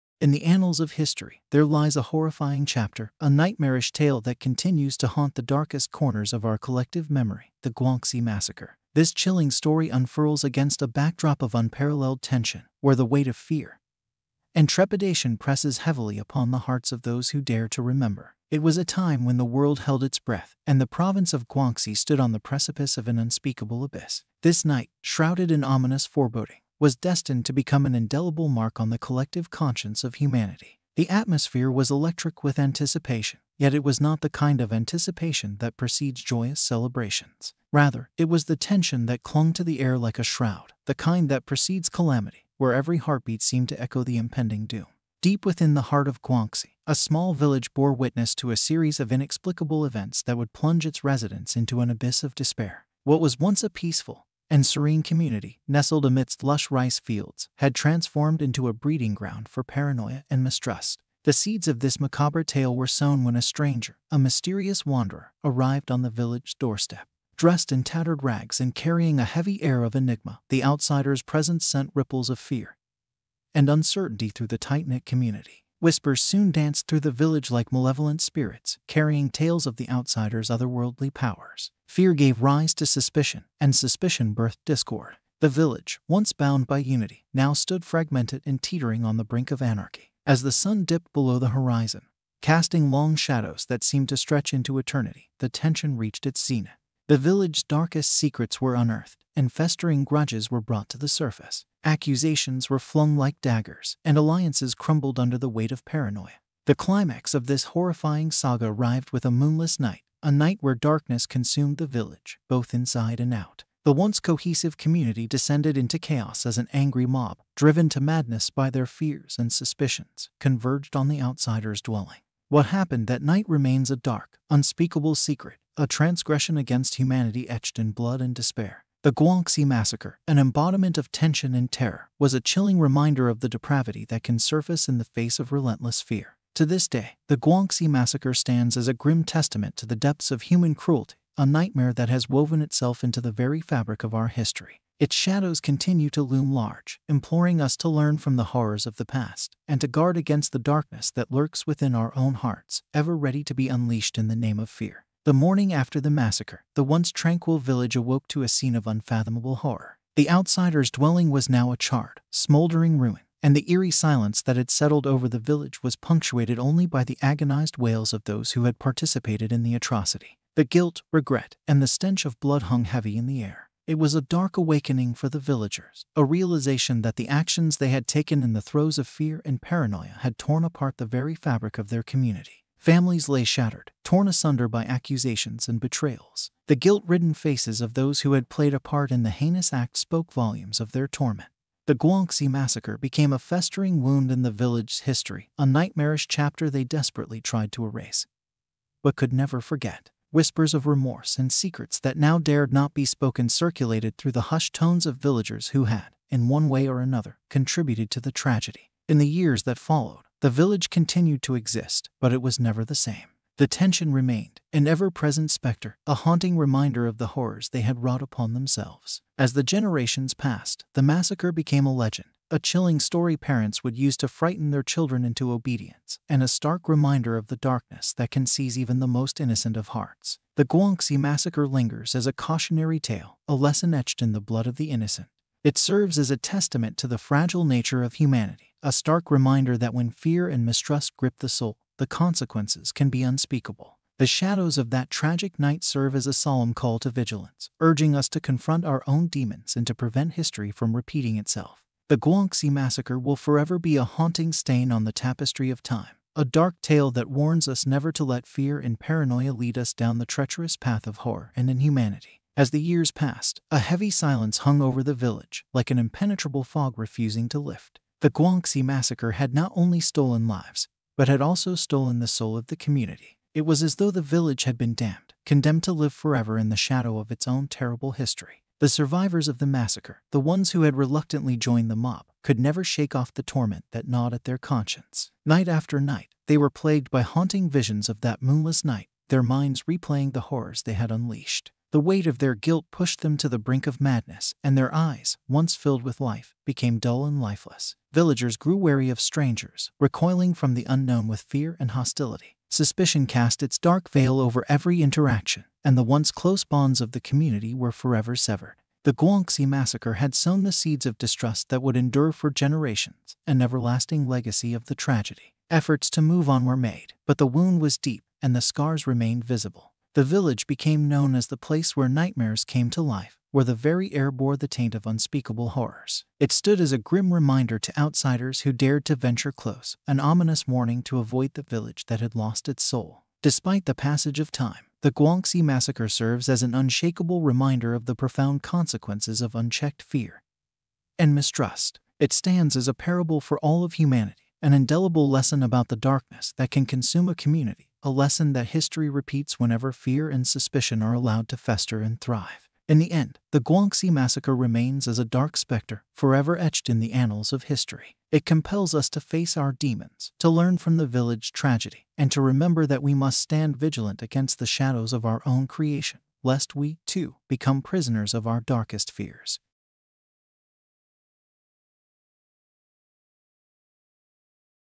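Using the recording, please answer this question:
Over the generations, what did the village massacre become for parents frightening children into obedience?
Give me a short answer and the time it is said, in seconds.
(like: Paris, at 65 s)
a legend, at 221 s.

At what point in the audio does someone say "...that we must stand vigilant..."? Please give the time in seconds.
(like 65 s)
362 s.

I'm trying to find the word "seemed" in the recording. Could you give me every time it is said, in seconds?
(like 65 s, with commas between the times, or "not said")
43 s, 93 s.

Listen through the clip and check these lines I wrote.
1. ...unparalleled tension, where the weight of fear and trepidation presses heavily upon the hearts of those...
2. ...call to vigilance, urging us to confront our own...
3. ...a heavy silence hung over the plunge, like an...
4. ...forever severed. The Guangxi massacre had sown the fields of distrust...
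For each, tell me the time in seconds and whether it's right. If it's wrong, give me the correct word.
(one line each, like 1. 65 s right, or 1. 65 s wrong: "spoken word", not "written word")
1. 11 s right
2. 246 s right
3. 263 s wrong: "village", not "plunge"
4. 307 s wrong: "seeds", not "fields".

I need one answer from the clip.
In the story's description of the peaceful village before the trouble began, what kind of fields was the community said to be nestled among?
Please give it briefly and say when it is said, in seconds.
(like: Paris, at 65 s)
lush rice fields, at 56 s.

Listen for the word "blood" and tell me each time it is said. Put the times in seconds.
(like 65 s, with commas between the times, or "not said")
127 s, 172 s, 234 s.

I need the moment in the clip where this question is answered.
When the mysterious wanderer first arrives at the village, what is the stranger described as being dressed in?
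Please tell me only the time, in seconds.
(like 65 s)
67 s.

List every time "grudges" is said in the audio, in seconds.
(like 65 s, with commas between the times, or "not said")
100 s.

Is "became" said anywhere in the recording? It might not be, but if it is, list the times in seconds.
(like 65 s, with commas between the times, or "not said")
192 s, 221 s, 296 s, 320 s.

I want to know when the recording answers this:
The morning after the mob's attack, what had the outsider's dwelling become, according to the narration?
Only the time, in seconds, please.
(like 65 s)
161 s.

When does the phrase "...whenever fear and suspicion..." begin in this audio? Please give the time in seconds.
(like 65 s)
349 s.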